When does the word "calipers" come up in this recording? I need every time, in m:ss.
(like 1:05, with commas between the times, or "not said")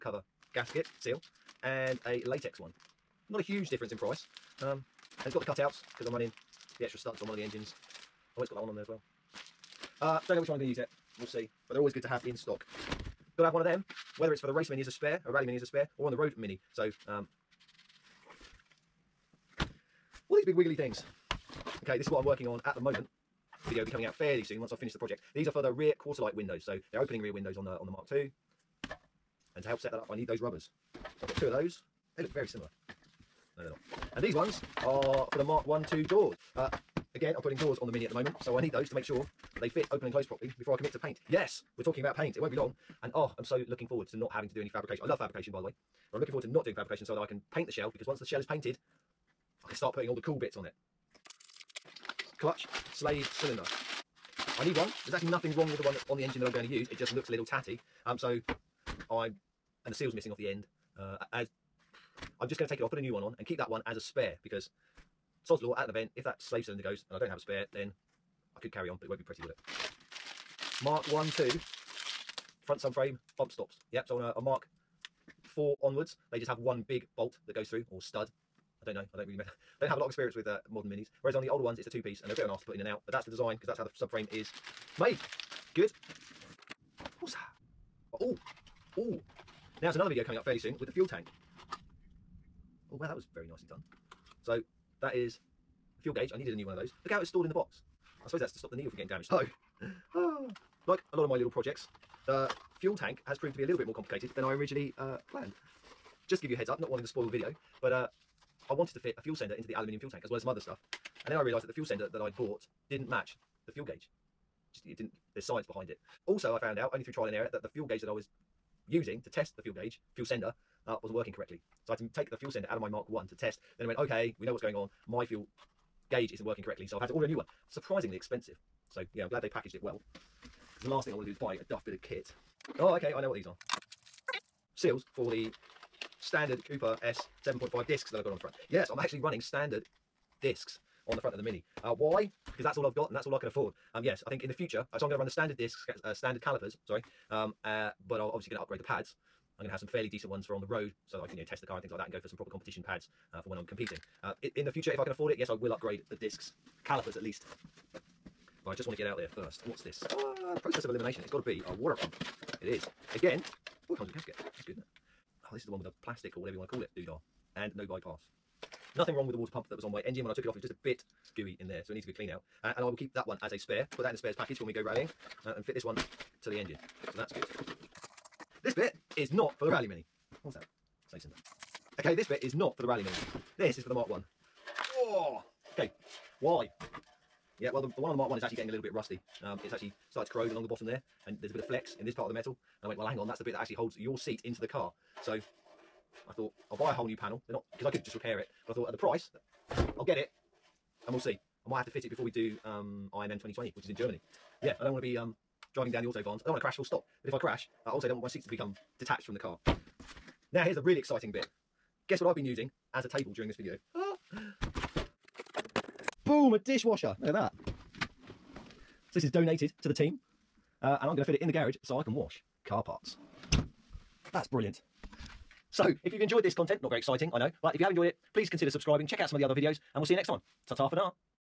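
2:26, 2:36.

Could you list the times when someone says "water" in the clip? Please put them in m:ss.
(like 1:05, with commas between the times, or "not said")
2:41, 2:49.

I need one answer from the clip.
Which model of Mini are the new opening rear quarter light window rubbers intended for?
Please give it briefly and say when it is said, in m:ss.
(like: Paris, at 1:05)
Mark II, at 0:27.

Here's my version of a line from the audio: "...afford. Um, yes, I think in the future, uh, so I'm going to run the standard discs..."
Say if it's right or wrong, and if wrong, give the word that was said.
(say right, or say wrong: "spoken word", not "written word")
right.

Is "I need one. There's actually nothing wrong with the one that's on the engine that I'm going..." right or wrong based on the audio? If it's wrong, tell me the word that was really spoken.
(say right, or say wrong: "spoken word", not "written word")
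right.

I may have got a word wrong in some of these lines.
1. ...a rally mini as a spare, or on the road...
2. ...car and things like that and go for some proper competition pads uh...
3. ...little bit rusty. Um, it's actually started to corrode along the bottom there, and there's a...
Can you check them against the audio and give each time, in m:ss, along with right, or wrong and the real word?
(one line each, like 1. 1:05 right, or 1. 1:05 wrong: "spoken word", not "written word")
1. 0:15 right
2. 2:31 right
3. 3:08 right.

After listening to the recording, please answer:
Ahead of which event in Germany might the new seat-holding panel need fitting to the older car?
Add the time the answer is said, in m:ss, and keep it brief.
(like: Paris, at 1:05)
IMM 2020, at 3:23.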